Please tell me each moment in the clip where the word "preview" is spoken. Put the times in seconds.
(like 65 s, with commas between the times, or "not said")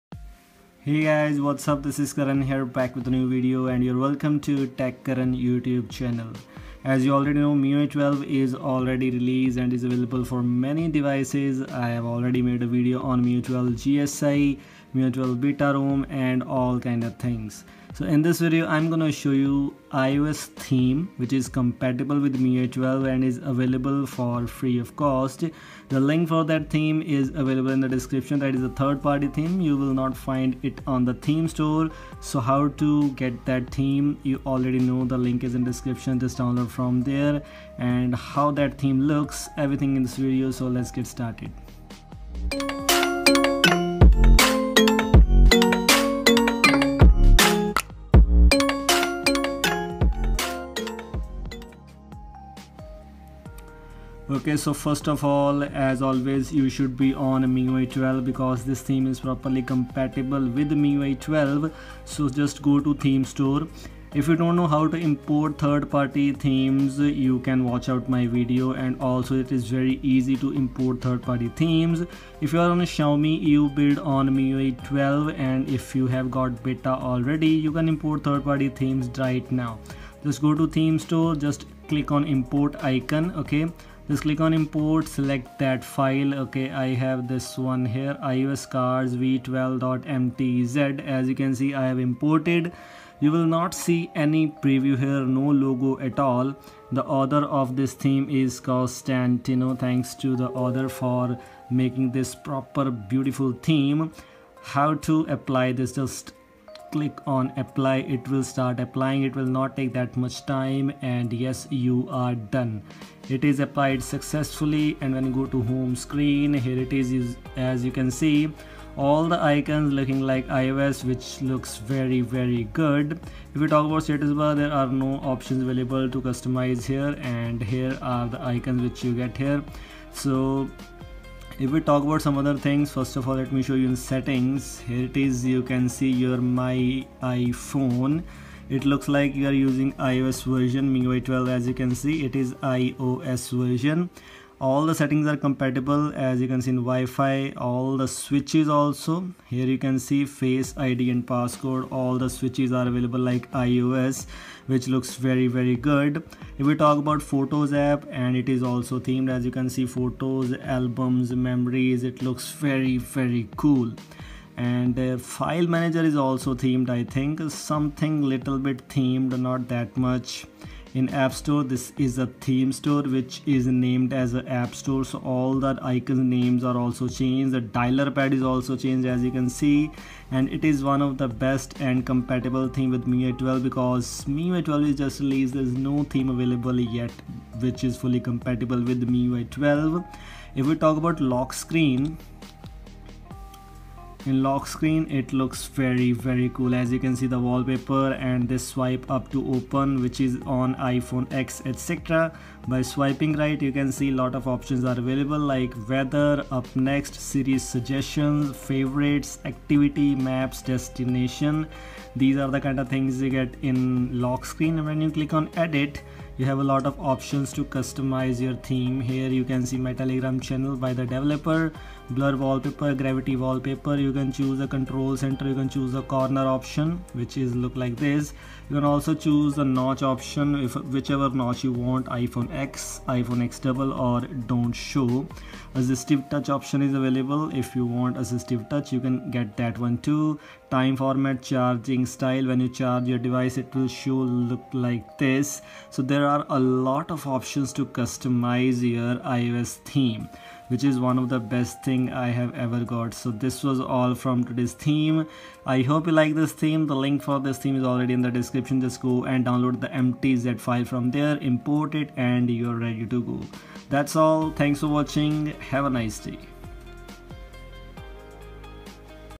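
94 s.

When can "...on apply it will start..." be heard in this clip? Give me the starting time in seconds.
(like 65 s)
107 s.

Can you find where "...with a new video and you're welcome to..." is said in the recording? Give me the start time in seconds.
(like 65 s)
2 s.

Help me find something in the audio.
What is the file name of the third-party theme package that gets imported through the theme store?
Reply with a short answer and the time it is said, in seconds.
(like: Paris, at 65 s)
ios cards v12.mtz, at 88 s.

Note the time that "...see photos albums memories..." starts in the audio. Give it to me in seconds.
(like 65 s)
159 s.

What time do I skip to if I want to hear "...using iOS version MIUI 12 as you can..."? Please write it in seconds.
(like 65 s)
139 s.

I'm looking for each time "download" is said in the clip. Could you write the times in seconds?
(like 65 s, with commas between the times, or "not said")
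36 s, 259 s.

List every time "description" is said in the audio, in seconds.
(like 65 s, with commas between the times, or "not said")
27 s, 35 s, 258 s.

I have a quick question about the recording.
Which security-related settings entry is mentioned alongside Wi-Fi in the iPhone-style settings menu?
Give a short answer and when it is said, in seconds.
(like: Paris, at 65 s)
face ID and passcode, at 150 s.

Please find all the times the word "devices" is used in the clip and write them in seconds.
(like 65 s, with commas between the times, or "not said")
10 s, 243 s.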